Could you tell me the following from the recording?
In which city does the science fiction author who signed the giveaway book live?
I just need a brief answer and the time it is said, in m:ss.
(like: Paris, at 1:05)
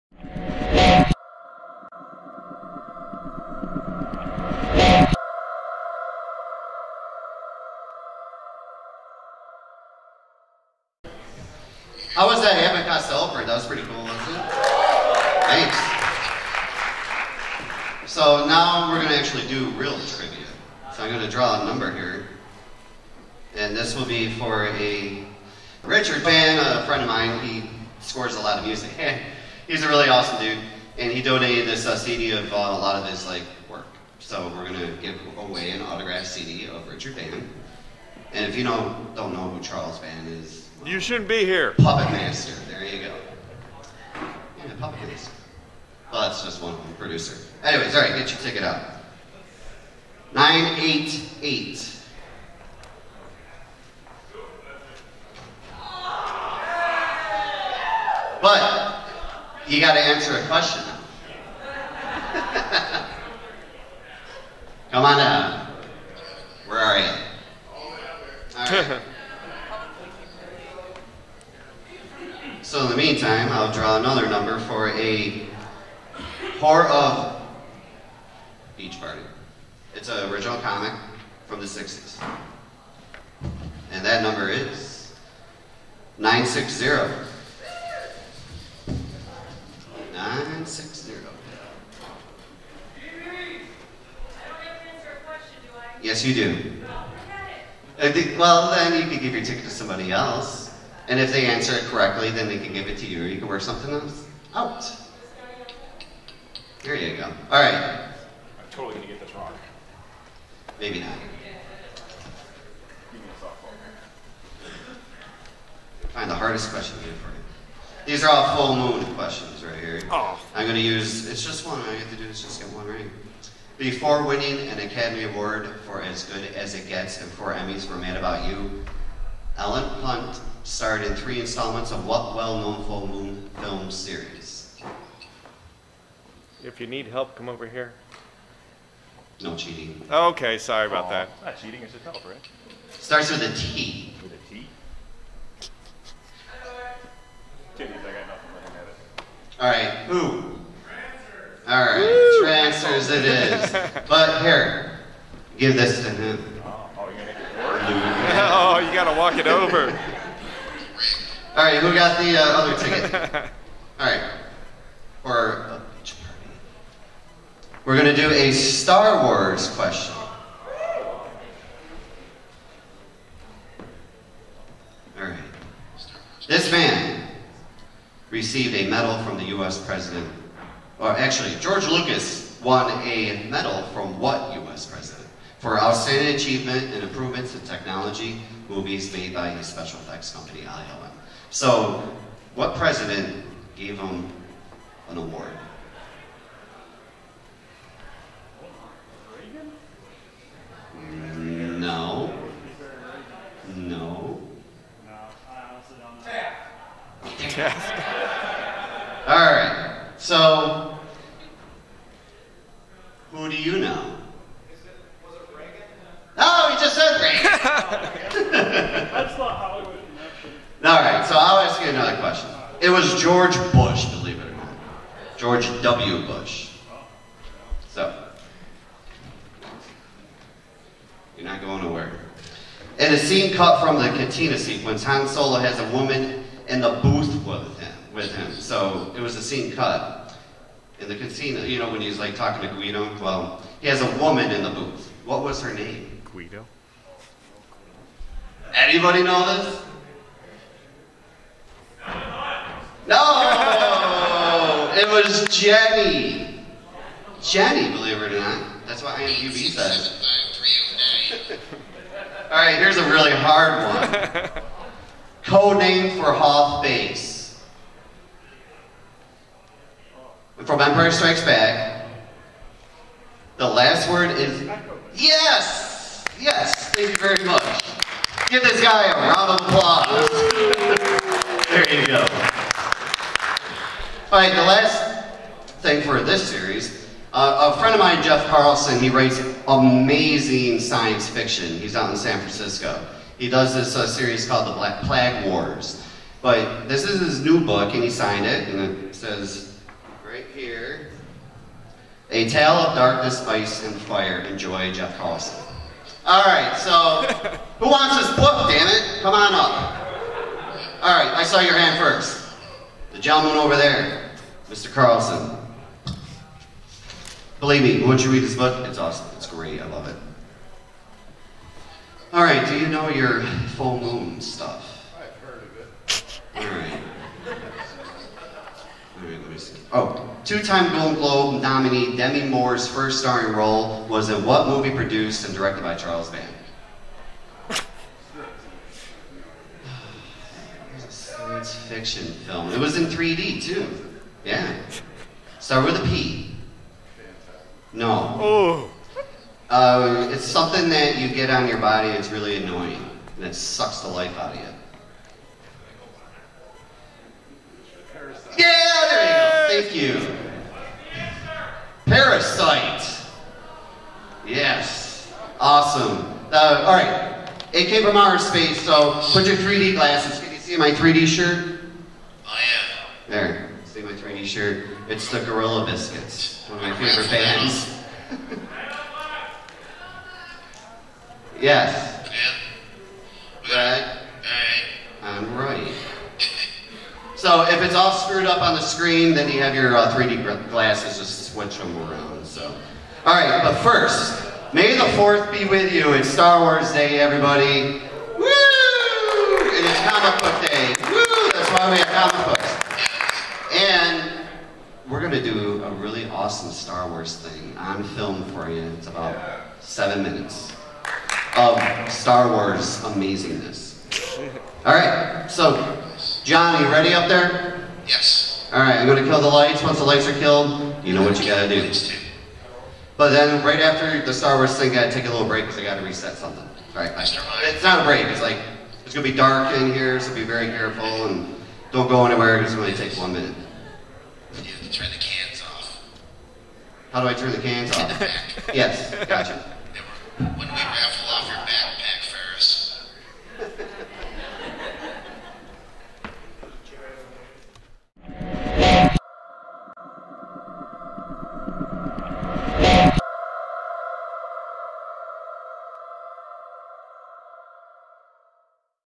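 San Francisco, at 4:52.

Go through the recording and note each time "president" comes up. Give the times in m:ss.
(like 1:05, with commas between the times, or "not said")
2:59, 3:04, 3:12.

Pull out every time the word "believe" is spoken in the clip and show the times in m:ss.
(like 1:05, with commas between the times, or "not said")
3:44, 4:17, 5:17.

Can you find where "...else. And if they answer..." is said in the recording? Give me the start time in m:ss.
1:40.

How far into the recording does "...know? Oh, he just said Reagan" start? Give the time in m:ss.
3:33.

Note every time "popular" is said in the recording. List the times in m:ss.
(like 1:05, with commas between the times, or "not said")
not said.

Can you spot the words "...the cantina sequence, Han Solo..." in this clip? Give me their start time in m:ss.
3:53.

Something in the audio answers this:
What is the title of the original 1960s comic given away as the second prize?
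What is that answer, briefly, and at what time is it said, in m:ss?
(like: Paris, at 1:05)
Horror of Beach Party, at 1:16.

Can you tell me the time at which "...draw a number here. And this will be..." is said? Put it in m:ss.
0:21.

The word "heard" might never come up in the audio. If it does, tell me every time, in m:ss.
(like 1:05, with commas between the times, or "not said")
5:25.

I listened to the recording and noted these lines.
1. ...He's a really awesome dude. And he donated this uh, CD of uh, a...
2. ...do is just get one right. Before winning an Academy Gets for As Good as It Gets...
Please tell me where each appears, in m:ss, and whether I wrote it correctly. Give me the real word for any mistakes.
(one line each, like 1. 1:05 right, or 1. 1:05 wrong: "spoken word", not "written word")
1. 0:29 right
2. 2:02 wrong: "Award", not "Gets".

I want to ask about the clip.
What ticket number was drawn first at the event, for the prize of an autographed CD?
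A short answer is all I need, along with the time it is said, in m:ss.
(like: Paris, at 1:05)
988, at 0:50.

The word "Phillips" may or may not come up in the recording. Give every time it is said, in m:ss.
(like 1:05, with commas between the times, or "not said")
not said.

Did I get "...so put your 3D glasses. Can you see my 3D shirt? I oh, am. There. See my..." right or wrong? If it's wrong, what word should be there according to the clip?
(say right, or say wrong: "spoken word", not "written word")
right.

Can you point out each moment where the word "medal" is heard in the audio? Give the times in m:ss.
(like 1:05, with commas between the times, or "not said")
2:58, 3:03.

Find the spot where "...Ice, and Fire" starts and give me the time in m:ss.
5:03.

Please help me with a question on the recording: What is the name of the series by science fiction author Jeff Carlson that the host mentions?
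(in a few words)
The Black Plague Wars.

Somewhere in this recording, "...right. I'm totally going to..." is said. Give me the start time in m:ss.
1:47.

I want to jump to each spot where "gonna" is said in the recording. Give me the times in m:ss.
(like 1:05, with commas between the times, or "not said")
2:37, 6:59, 7:09.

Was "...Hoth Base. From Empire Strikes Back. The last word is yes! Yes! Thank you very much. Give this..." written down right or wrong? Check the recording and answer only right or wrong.
right.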